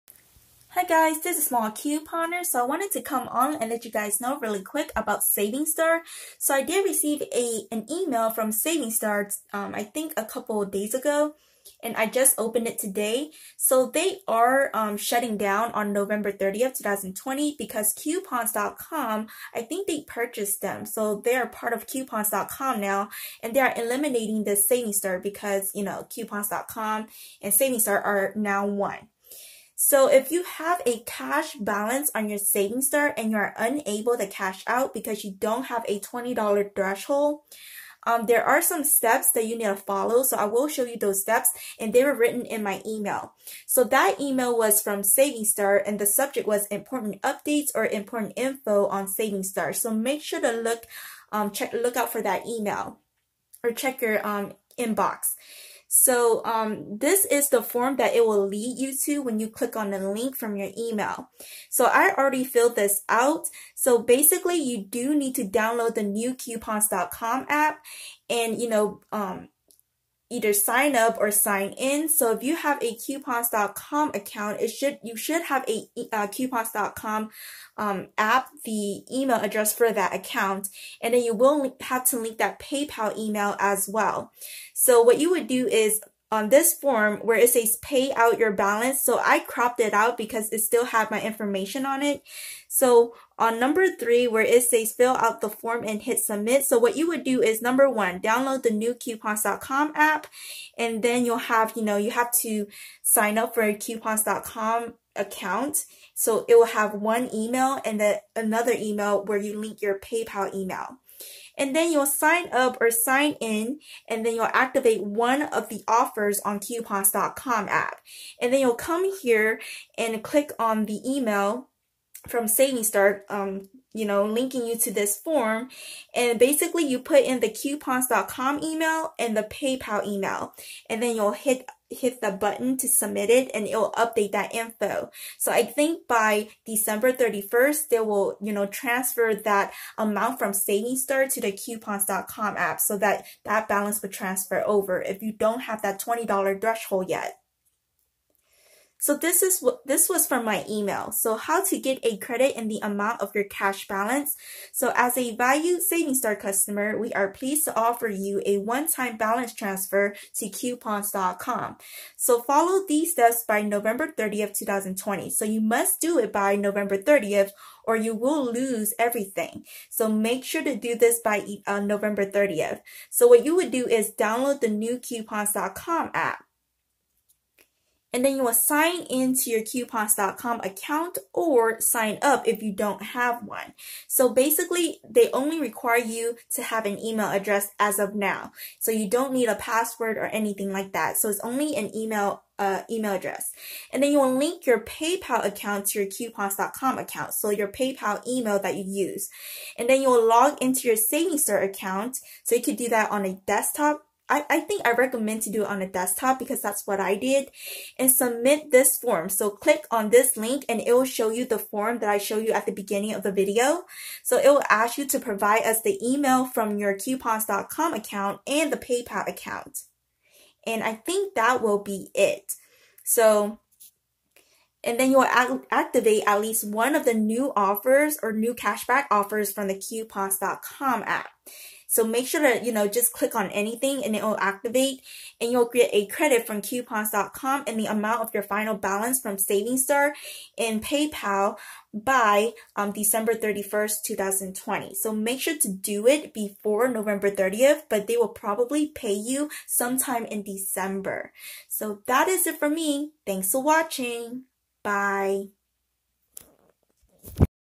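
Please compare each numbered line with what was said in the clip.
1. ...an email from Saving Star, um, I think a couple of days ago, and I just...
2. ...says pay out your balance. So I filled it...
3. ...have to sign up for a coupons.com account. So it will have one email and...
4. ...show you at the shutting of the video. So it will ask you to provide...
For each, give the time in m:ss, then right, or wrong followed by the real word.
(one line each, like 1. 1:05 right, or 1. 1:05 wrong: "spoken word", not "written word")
1. 0:07 right
2. 1:27 wrong: "cropped", not "filled"
3. 1:42 right
4. 3:32 wrong: "beginning", not "shutting".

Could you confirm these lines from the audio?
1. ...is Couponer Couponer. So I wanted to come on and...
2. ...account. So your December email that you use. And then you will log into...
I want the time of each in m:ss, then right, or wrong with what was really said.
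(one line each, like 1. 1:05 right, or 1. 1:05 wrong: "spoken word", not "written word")
1. 0:01 wrong: "Small", not "Couponer"
2. 3:16 wrong: "PayPal", not "December".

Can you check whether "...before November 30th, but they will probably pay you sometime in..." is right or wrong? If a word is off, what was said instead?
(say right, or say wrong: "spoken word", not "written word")
right.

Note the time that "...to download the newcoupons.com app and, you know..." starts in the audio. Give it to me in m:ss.
1:05.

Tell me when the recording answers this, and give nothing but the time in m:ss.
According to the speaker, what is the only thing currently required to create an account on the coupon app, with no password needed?
3:05.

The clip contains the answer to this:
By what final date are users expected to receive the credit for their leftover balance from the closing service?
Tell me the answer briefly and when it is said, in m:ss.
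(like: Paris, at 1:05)
December 31st, 2020, at 4:02.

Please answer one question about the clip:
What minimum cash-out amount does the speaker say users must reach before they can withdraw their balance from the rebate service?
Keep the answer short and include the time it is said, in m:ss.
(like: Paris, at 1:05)
$20, at 0:35.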